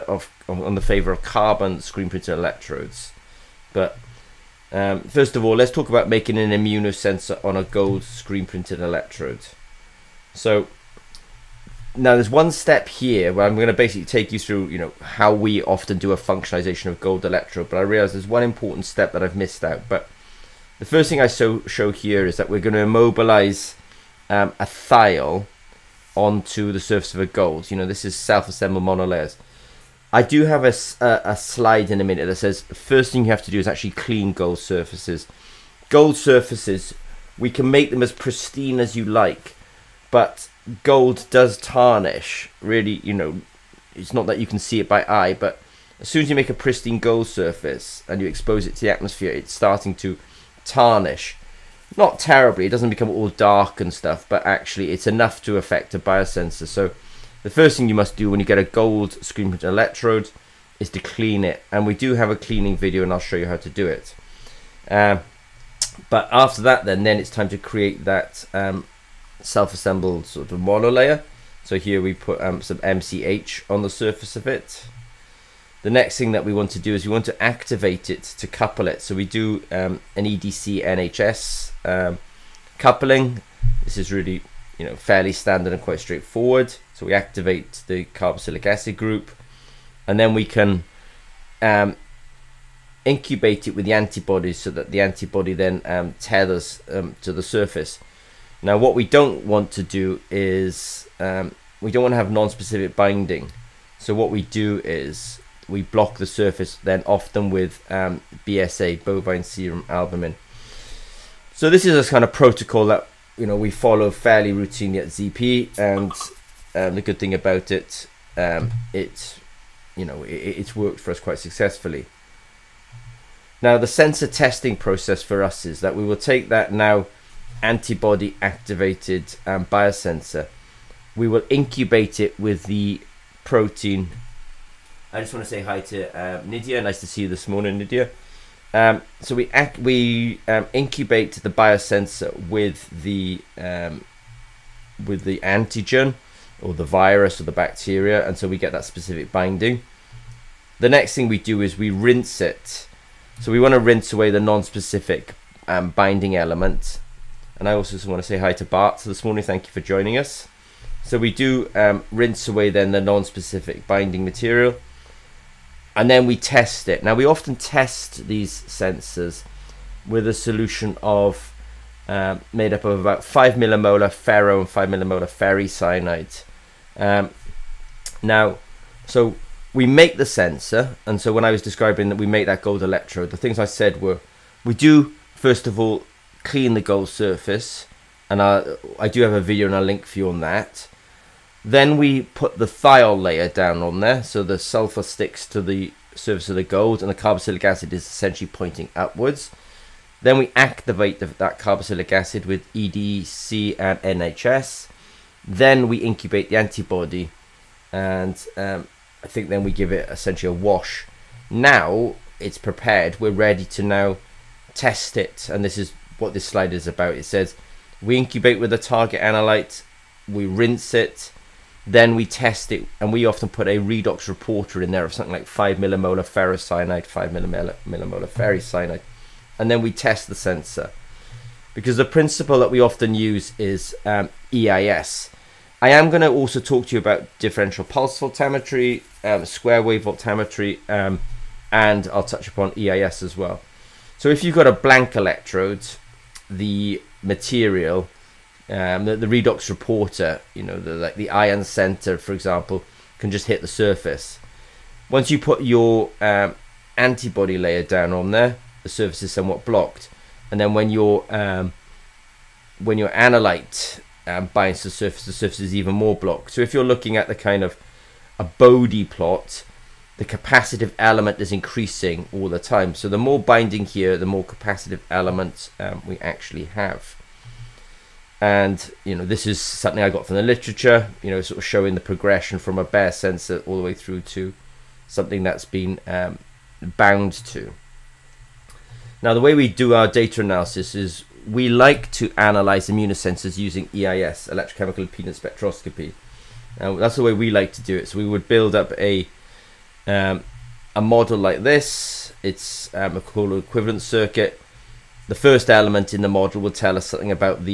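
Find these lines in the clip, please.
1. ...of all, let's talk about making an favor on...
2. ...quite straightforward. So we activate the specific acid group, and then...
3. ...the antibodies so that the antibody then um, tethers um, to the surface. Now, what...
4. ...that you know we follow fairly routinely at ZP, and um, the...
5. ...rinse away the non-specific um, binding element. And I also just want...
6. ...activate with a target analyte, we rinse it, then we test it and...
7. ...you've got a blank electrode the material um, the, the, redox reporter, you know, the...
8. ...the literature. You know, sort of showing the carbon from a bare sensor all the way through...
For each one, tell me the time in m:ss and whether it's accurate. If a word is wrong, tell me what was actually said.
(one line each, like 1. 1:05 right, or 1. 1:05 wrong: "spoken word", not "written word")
1. 0:05 wrong: "immunosensor", not "favor"
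2. 1:25 wrong: "carboxylic", not "specific"
3. 1:33 right
4. 1:52 right
5. 2:33 right
6. 3:38 wrong: "incubate", not "activate"
7. 4:04 right
8. 4:40 wrong: "progression", not "carbon".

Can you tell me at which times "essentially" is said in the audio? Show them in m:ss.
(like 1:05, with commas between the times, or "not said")
3:18, 3:30.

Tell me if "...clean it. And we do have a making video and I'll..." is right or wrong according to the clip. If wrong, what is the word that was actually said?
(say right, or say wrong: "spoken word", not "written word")
wrong: "cleaning", not "making".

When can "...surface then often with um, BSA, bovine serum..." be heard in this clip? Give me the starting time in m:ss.
1:46.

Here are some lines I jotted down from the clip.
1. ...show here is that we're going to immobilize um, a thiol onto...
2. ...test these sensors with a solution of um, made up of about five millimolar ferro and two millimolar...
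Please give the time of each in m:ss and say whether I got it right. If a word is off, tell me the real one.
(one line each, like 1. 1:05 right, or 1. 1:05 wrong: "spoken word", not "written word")
1. 0:21 right
2. 2:47 wrong: "five", not "two".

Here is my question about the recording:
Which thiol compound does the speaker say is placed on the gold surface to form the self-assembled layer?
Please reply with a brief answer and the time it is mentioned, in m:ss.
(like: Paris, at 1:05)
MCH, at 1:12.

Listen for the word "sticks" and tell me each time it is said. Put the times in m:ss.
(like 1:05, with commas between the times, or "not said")
3:15.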